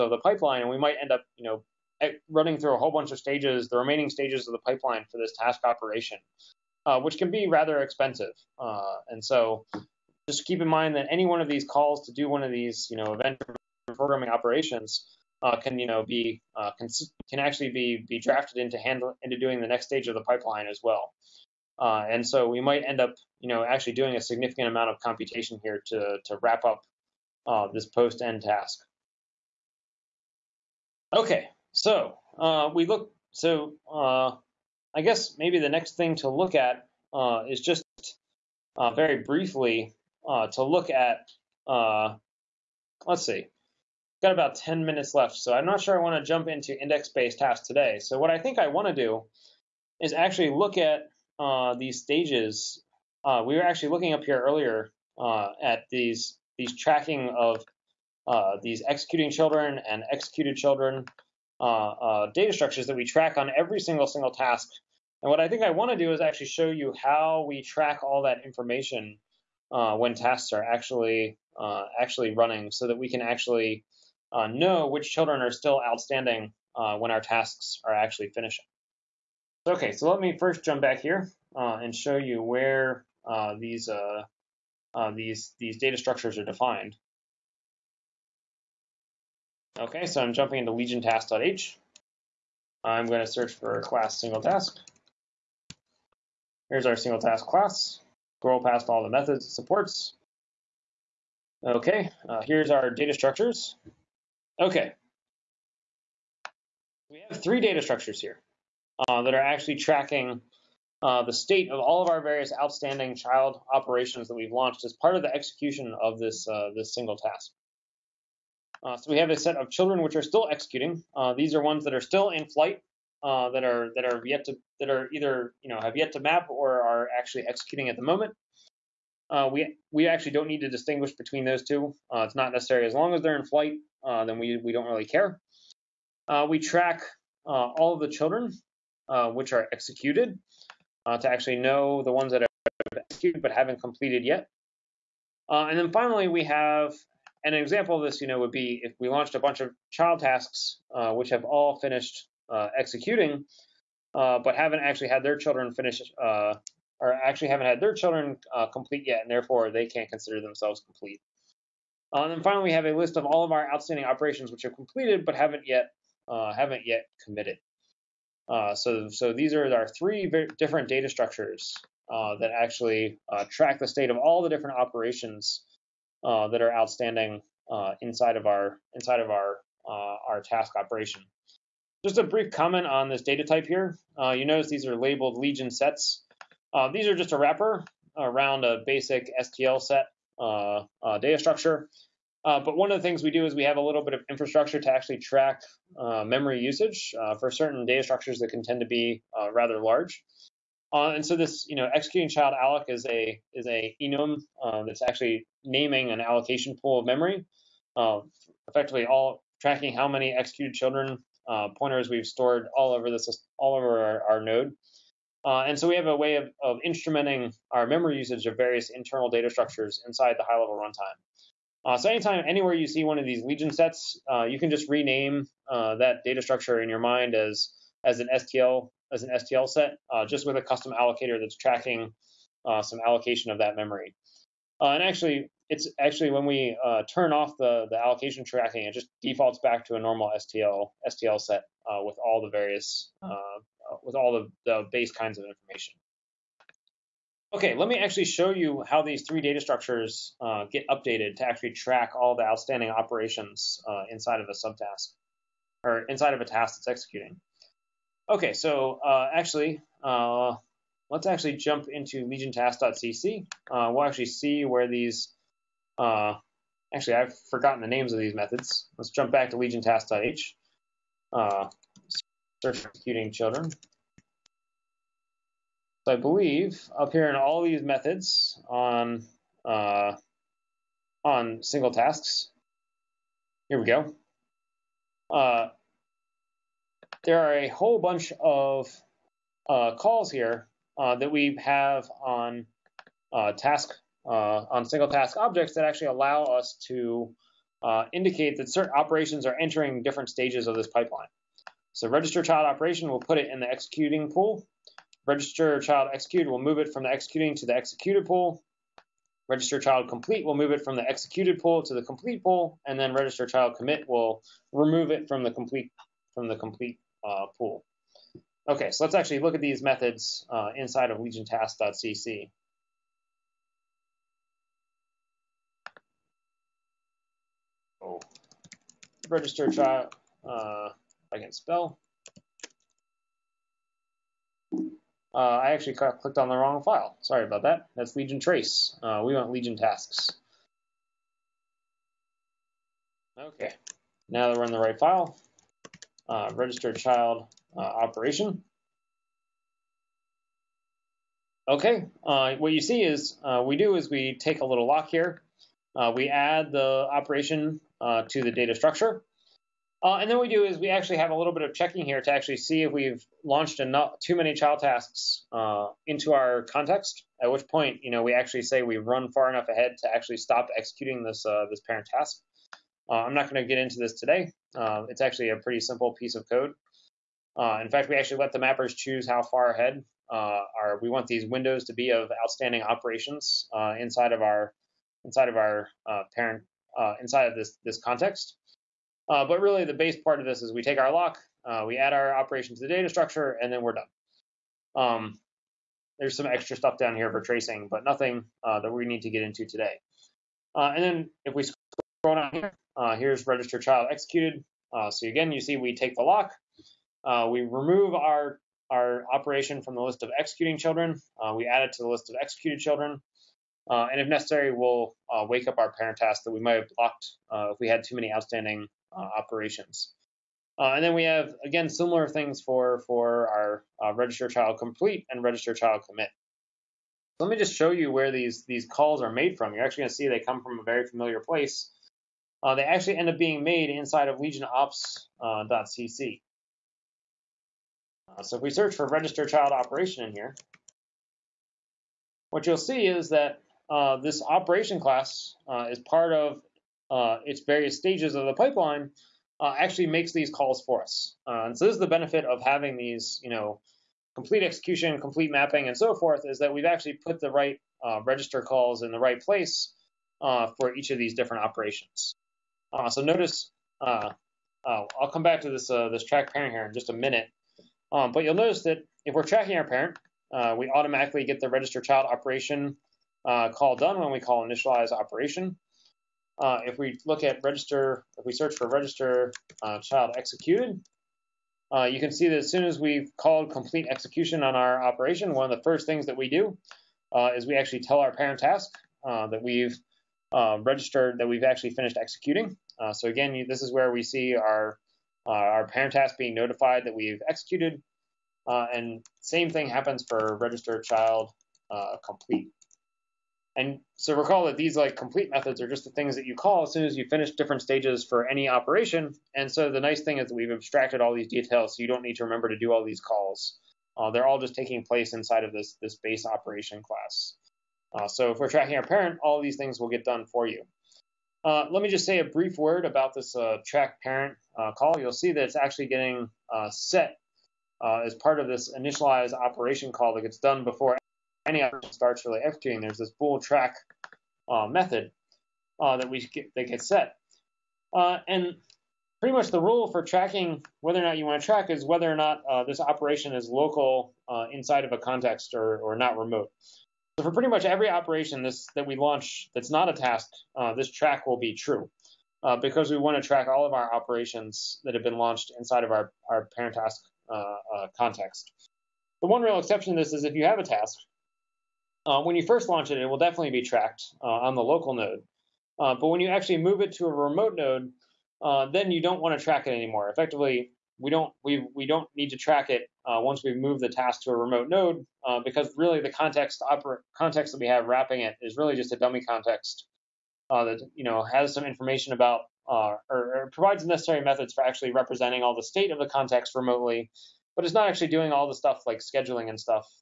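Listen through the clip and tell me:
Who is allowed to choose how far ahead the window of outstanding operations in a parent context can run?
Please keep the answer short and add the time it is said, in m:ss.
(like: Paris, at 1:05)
the mappers, at 6:18.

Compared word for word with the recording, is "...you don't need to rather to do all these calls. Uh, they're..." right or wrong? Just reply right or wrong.
wrong.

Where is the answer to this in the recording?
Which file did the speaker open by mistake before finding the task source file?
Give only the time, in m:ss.
5:38.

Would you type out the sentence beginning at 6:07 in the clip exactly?
At which point, you know, we actually say we've run far enough ahead to actually stop executing this uh, this parent task.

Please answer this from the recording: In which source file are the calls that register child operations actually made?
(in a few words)
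legionops.cc.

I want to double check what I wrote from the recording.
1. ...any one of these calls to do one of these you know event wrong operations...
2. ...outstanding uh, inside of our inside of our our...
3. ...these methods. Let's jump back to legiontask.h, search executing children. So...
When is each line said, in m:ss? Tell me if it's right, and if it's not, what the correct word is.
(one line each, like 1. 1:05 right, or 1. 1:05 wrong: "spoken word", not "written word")
1. 0:11 wrong: "programming", not "wrong"
2. 2:56 right
3. 4:28 right.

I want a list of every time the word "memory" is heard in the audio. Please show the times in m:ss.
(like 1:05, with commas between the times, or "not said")
3:16, 3:27, 3:37, 3:53.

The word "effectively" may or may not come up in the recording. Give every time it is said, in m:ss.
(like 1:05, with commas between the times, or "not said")
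3:28, 9:30.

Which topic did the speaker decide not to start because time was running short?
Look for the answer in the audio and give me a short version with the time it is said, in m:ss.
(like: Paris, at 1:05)
index-based tasks, at 0:46.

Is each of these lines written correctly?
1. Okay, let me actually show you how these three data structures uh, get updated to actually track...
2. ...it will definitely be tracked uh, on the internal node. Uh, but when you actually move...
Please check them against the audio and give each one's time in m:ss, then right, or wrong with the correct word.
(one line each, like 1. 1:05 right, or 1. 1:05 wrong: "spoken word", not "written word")
1. 4:07 right
2. 9:23 wrong: "local", not "internal".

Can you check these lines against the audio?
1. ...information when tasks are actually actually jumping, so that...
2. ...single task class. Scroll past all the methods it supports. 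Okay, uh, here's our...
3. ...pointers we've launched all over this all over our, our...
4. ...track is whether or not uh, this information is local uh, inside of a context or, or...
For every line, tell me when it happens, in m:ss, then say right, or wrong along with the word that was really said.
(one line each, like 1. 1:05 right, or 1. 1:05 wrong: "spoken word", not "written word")
1. 1:08 wrong: "running", not "jumping"
2. 1:36 right
3. 3:31 wrong: "stored", not "launched"
4. 9:01 wrong: "operation", not "information".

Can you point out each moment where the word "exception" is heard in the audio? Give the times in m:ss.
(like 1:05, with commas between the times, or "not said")
9:19.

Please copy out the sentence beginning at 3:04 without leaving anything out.
you notice these are labeled legion sets.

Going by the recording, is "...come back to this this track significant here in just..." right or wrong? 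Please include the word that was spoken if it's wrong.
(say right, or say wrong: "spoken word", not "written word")
wrong: "parent", not "significant".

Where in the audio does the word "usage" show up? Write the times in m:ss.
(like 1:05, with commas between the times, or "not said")
3:16, 3:38.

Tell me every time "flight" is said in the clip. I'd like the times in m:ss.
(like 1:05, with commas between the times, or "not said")
2:02, 2:13.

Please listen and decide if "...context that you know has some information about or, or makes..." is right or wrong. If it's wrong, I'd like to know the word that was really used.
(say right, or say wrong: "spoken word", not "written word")
wrong: "provides", not "makes".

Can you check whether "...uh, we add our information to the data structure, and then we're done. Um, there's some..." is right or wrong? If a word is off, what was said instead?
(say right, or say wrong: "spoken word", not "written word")
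wrong: "operation", not "information".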